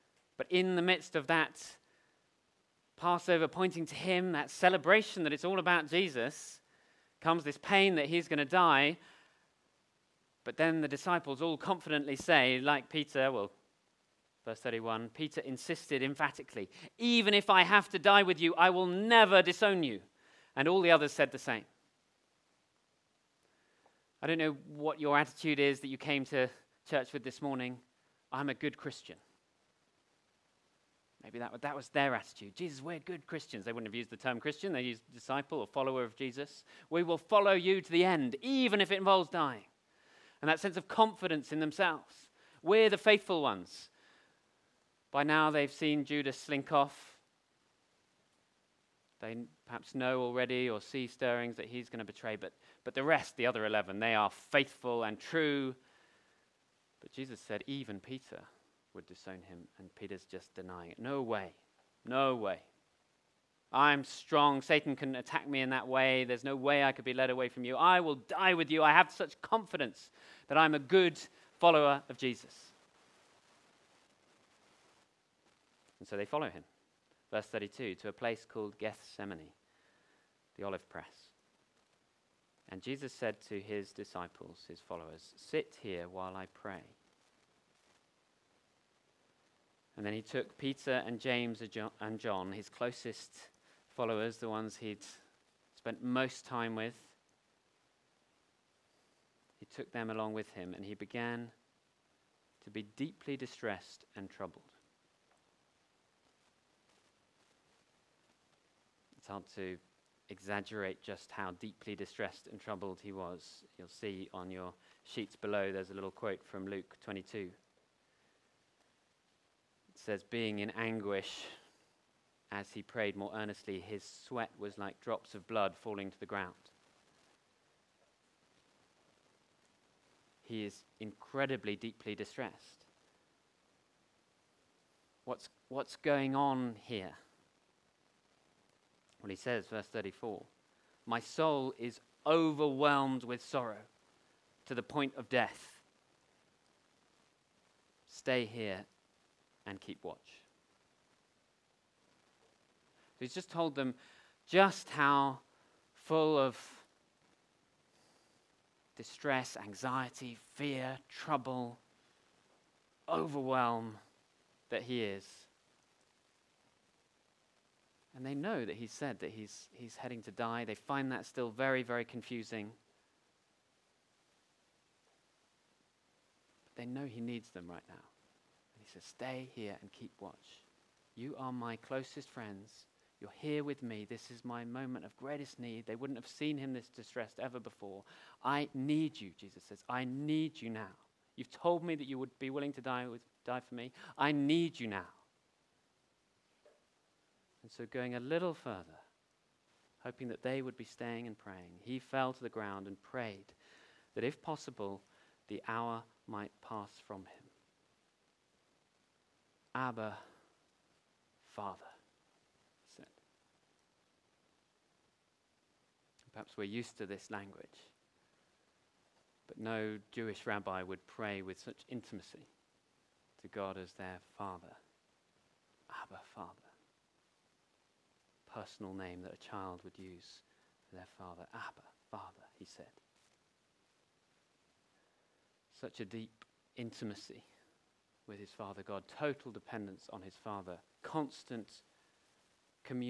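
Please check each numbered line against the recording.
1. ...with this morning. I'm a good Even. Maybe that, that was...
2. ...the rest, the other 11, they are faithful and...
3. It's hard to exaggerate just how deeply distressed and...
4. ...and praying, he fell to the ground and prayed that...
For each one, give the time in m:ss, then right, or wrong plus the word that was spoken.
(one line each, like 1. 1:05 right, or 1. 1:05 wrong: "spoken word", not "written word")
1. 0:27 wrong: "Christian", not "Even"
2. 0:52 right
3. 1:49 right
4. 3:21 right.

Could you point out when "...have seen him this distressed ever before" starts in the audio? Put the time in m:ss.
3:06.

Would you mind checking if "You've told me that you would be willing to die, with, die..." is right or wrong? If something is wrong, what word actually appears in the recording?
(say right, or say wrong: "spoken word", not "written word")
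right.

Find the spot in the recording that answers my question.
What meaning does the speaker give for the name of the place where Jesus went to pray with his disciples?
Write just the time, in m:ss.
1:20.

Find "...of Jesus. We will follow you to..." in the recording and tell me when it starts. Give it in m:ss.
0:36.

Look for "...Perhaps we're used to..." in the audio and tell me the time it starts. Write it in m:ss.
3:36.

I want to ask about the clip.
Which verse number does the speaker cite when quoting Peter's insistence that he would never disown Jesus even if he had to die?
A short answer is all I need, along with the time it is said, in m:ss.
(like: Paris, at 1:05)
31, at 0:14.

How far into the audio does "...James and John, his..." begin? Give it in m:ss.
1:31.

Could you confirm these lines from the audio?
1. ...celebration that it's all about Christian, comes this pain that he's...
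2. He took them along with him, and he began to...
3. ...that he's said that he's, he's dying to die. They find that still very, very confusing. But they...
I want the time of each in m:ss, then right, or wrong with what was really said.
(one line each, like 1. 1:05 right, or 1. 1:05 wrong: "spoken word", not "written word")
1. 0:04 wrong: "Jesus", not "Christian"
2. 1:39 right
3. 2:48 wrong: "heading", not "dying".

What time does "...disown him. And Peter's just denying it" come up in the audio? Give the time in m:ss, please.
0:59.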